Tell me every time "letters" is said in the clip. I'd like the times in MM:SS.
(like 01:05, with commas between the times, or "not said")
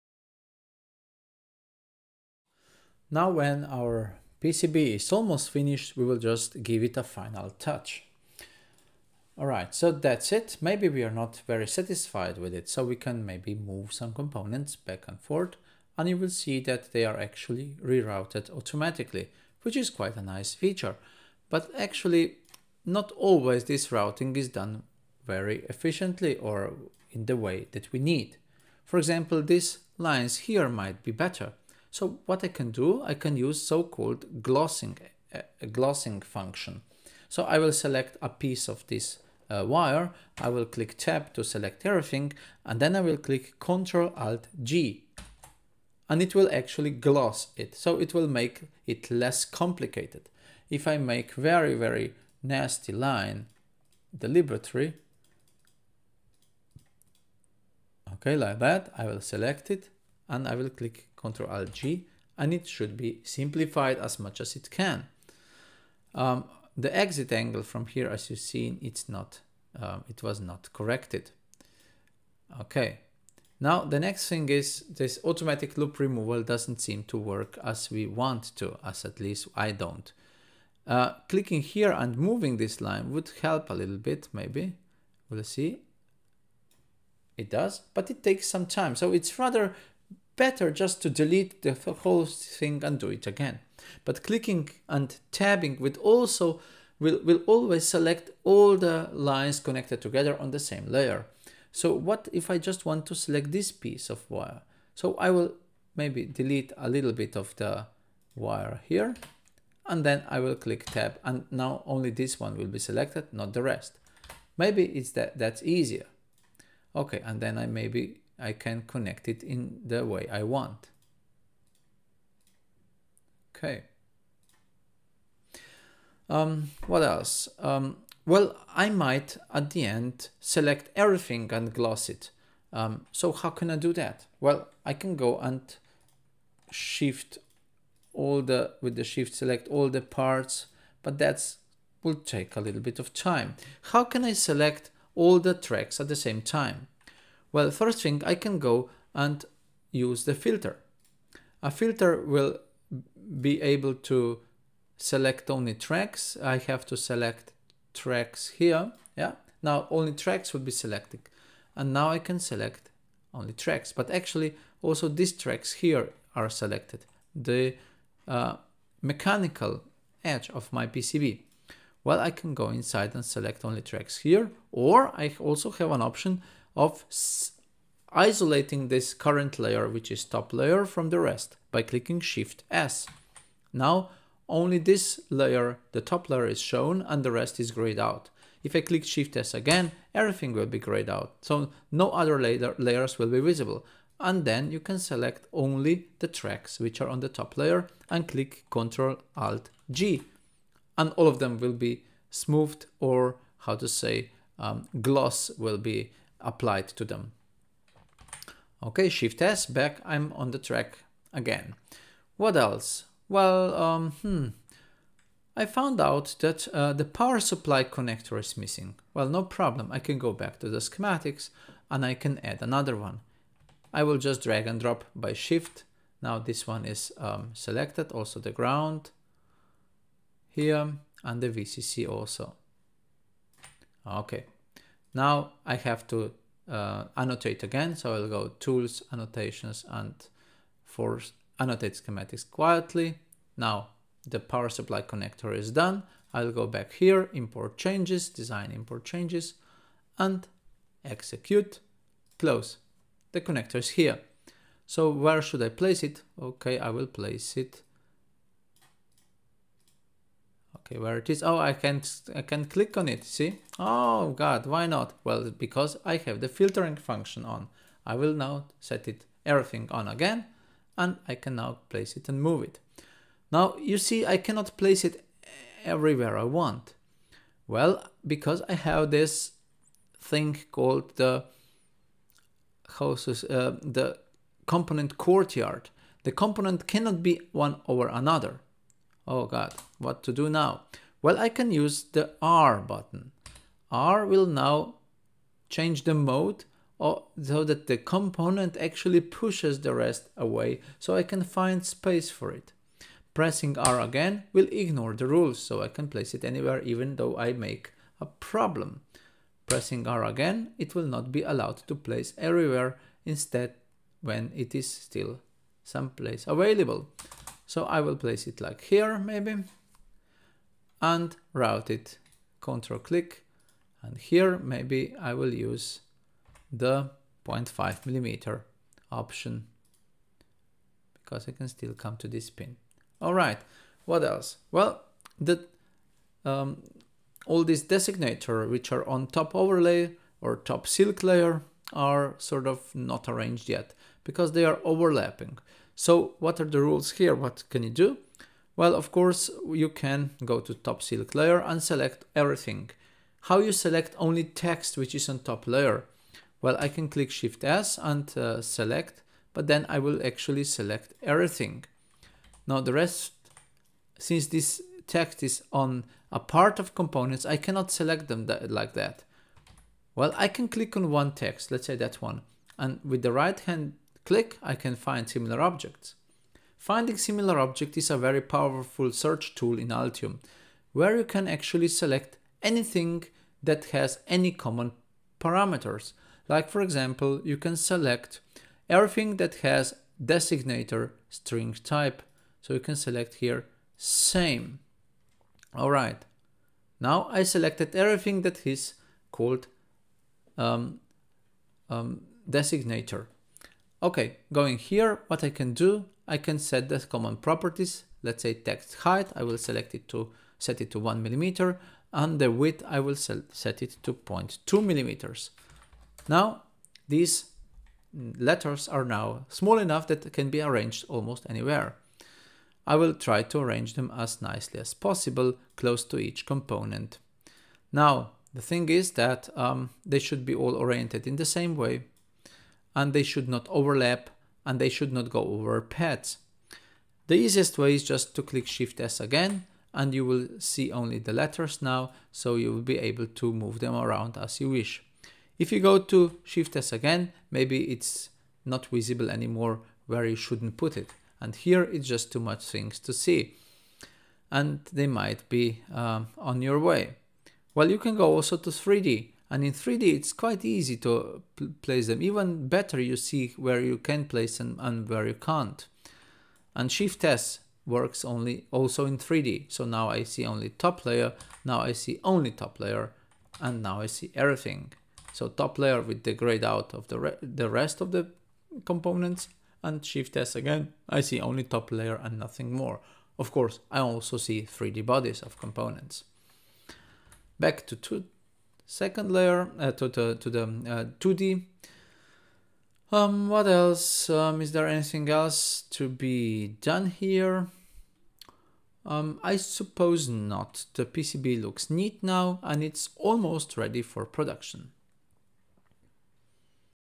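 06:58, 07:21.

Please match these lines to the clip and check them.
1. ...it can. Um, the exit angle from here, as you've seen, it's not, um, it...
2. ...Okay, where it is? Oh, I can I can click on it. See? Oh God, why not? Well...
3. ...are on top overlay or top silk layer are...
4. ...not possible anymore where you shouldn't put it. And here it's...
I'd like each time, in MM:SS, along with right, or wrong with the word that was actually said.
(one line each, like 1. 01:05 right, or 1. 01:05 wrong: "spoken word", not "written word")
1. 01:04 right
2. 04:20 right
3. 05:38 right
4. 07:28 wrong: "visible", not "possible".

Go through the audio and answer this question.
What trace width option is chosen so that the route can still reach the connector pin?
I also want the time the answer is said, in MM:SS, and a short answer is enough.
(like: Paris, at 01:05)
0.5 millimeter, at 05:27.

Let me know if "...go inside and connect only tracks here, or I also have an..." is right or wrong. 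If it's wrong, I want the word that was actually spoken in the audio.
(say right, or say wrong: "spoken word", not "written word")
wrong: "select", not "connect".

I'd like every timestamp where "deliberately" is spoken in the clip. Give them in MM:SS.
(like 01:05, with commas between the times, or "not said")
00:54.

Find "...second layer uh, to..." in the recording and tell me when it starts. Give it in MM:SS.
08:08.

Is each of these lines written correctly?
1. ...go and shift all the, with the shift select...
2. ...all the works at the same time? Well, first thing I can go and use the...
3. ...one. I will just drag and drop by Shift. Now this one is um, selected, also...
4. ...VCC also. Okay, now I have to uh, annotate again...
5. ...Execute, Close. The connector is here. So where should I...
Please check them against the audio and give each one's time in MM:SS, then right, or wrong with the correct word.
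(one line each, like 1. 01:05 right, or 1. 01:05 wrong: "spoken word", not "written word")
1. 02:15 right
2. 02:25 wrong: "tracks", not "works"
3. 03:42 right
4. 03:51 right
5. 04:11 right.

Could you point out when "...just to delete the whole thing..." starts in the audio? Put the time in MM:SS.
01:30.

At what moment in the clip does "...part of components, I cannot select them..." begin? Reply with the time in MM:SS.
06:06.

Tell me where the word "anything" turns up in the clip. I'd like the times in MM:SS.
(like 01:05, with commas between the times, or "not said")
06:22, 08:14.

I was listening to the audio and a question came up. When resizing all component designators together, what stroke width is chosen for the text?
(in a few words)
0.2 millimeters.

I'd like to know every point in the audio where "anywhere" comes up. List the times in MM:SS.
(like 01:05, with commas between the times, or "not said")
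05:06, 07:01.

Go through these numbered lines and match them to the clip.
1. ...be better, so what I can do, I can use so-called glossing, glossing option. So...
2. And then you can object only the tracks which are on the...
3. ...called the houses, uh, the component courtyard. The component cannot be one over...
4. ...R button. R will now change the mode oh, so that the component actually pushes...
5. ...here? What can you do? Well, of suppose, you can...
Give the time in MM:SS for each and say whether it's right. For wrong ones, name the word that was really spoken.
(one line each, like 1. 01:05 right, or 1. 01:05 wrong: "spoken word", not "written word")
1. 00:31 wrong: "function", not "option"
2. 03:14 wrong: "select", not "object"
3. 04:40 right
4. 04:52 right
5. 05:47 wrong: "course", not "suppose".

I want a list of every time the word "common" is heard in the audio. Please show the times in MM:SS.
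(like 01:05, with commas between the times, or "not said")
06:24, 06:46.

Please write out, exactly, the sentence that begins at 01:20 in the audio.
Uh, clicking here and moving this line would help a little bit, maybe.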